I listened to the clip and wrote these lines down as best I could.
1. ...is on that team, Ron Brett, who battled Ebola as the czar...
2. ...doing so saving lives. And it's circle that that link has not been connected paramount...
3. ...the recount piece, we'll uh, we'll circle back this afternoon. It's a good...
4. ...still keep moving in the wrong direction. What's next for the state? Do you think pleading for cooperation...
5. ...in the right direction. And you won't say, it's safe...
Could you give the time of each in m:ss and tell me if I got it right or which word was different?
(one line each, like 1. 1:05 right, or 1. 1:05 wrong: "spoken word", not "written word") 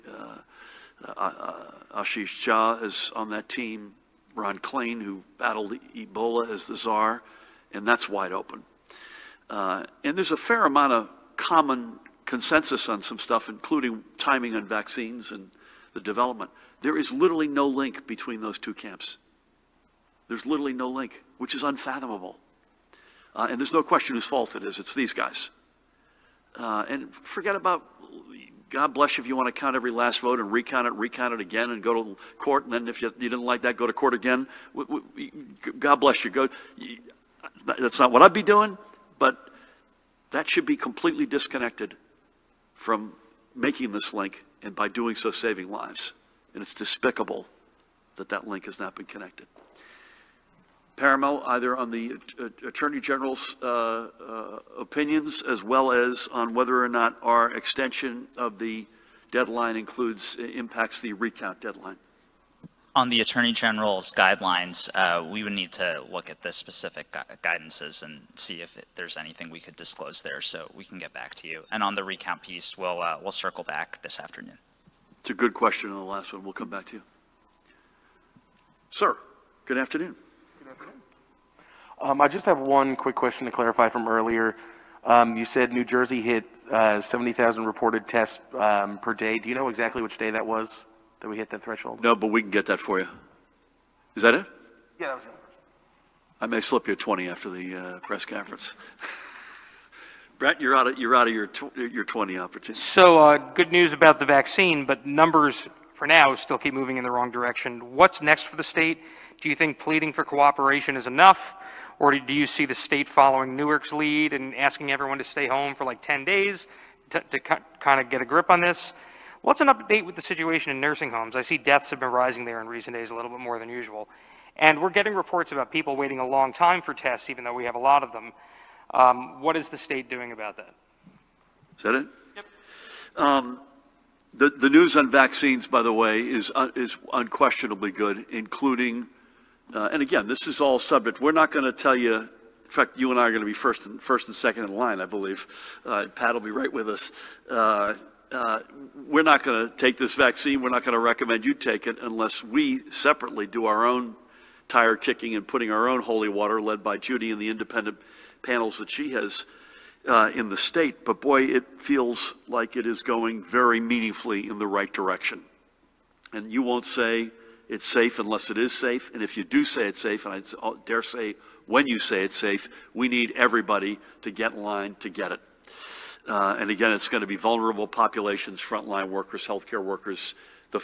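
1. 0:02 wrong: "Klain", not "Brett"
2. 0:44 wrong: "despicable", not "circle"
3. 1:11 right
4. 1:46 right
5. 2:44 right.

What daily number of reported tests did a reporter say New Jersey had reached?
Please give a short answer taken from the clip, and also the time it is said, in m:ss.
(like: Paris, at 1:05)
70,000, at 1:27.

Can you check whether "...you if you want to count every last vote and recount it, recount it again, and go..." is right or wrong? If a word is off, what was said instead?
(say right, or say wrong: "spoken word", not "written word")
right.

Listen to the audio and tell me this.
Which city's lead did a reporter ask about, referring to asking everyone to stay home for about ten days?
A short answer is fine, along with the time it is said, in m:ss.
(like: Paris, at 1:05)
Newark, at 1:53.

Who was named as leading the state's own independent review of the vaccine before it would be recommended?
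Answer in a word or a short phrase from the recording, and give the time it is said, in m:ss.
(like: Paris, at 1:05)
Judy, at 2:36.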